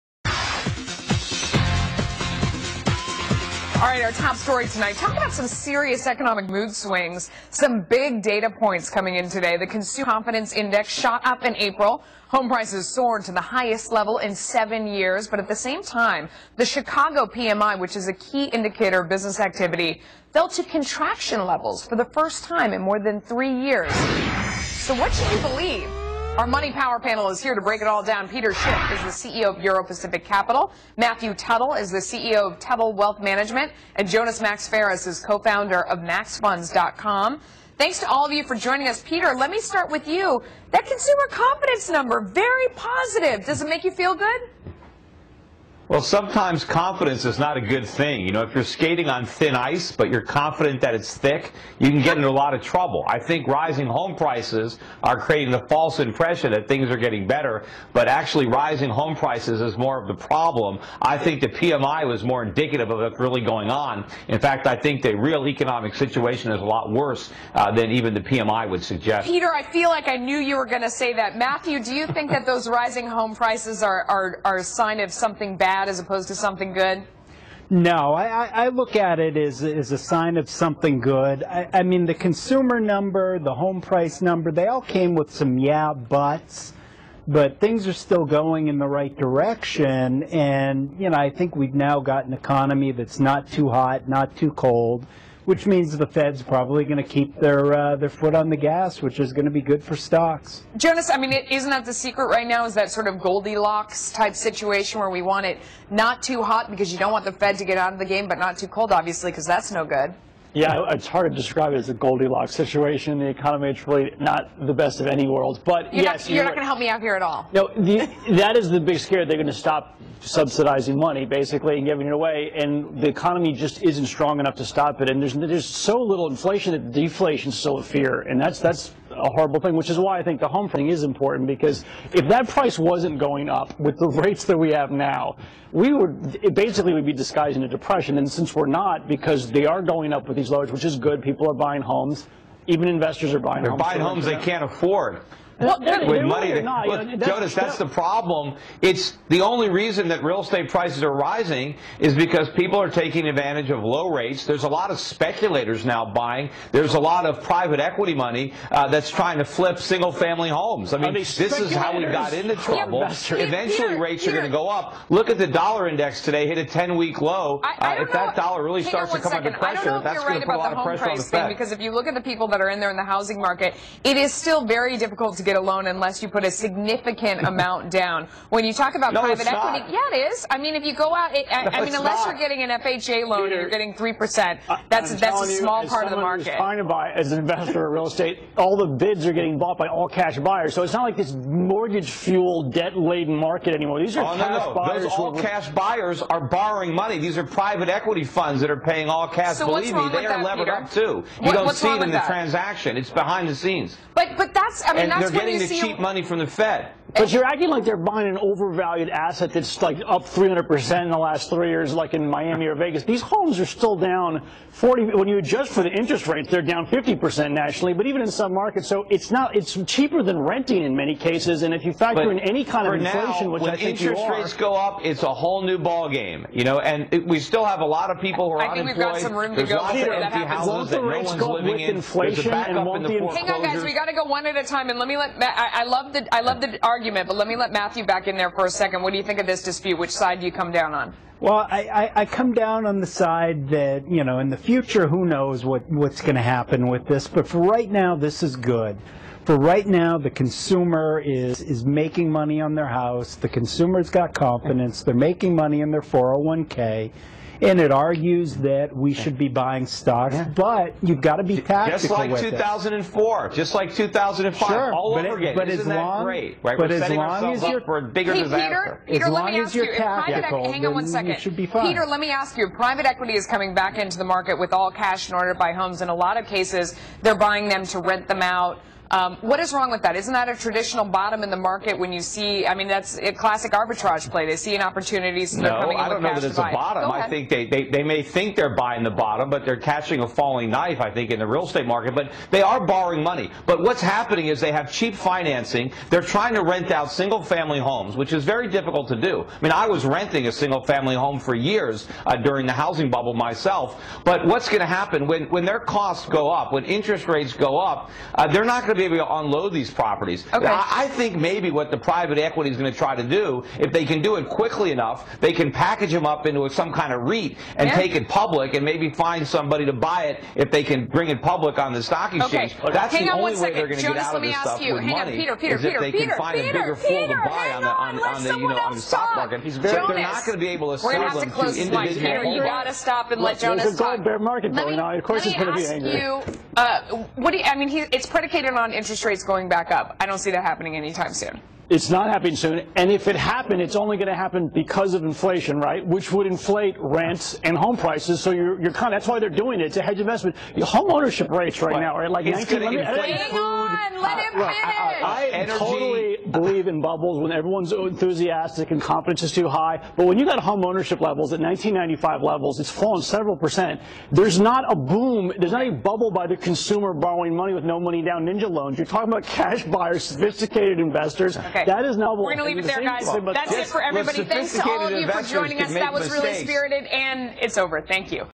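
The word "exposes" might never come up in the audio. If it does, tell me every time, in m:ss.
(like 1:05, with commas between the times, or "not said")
not said.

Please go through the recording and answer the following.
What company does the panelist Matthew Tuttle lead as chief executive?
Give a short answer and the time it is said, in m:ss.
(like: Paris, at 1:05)
Tuttle Wealth Management, at 0:32.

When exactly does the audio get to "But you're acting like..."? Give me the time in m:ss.
3:27.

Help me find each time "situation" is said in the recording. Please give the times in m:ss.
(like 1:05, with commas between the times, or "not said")
1:05, 1:44, 1:52.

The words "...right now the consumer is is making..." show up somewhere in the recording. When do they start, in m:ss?
4:09.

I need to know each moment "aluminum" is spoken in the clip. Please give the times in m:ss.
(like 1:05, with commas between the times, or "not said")
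not said.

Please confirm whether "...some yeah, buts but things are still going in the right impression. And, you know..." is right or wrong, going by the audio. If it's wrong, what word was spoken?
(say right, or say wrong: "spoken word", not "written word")
wrong: "direction", not "impression".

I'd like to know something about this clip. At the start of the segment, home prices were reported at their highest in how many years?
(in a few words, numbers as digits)
7.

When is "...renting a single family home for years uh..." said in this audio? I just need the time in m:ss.
5:00.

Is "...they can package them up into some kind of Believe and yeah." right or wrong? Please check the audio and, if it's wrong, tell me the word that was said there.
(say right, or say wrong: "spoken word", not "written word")
wrong: "REIT", not "Believe".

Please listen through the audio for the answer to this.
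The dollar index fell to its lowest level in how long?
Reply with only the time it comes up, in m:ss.
2:46.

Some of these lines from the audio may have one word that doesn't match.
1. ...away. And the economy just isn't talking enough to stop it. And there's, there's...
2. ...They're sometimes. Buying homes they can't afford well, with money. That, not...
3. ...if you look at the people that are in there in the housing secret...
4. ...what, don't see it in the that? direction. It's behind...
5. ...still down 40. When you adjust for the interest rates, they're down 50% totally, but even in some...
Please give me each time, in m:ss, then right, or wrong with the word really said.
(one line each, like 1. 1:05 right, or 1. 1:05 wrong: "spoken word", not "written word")
1. 2:02 wrong: "strong", not "talking"
2. 2:23 wrong: "homes", not "sometimes"
3. 2:51 wrong: "market", not "secret"
4. 3:21 wrong: "transaction", not "direction"
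5. 3:33 wrong: "nationally", not "totally".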